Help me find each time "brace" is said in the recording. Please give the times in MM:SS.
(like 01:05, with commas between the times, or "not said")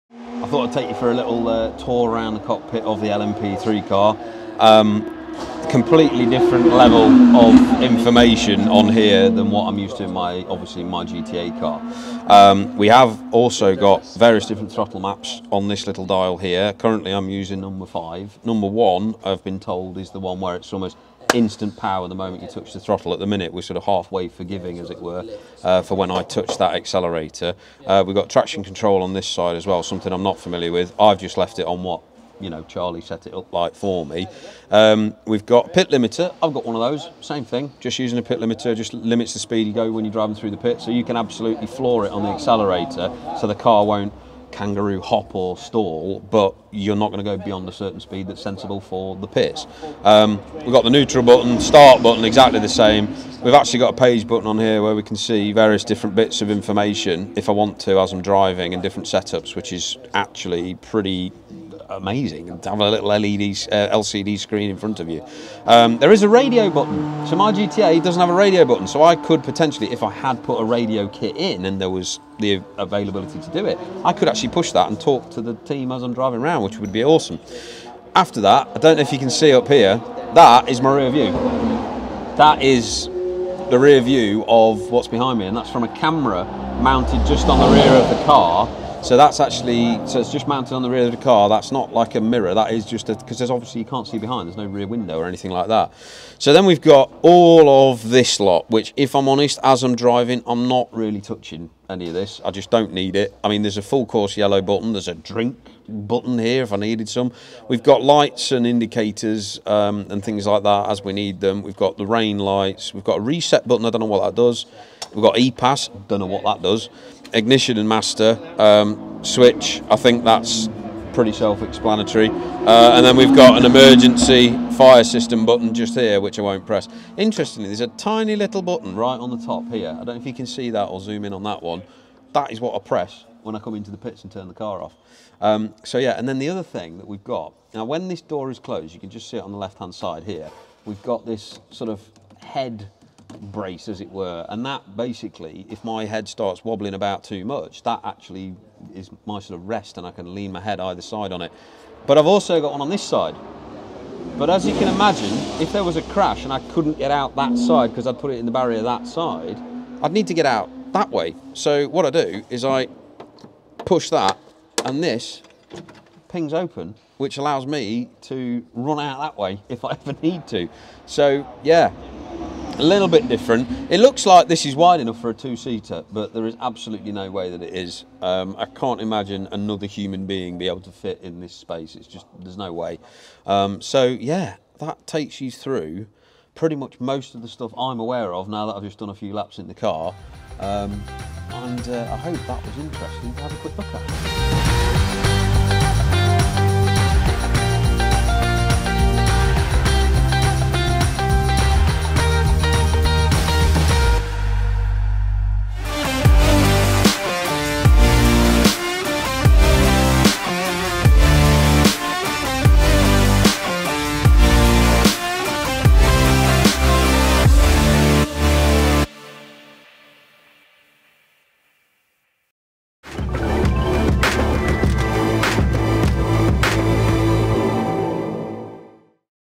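02:23.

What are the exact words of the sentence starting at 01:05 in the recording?
Um, there is a radio button.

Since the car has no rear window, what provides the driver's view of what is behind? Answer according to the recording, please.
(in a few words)
A camera.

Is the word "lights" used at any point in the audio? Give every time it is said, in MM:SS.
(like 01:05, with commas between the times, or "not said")
01:48, 01:52.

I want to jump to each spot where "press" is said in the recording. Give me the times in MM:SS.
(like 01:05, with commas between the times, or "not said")
02:06, 02:12.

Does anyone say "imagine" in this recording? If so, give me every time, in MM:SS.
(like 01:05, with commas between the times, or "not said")
02:34, 02:59.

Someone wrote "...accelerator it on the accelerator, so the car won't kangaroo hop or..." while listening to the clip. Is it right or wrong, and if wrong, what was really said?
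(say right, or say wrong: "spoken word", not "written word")
wrong: "floor", not "accelerator".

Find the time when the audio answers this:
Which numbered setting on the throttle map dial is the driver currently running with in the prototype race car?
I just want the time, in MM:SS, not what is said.
00:17.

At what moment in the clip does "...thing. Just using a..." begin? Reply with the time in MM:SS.
00:37.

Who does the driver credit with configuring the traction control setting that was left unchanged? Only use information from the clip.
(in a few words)
Charlie.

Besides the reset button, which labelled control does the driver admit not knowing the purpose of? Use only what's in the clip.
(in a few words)
E-Pass.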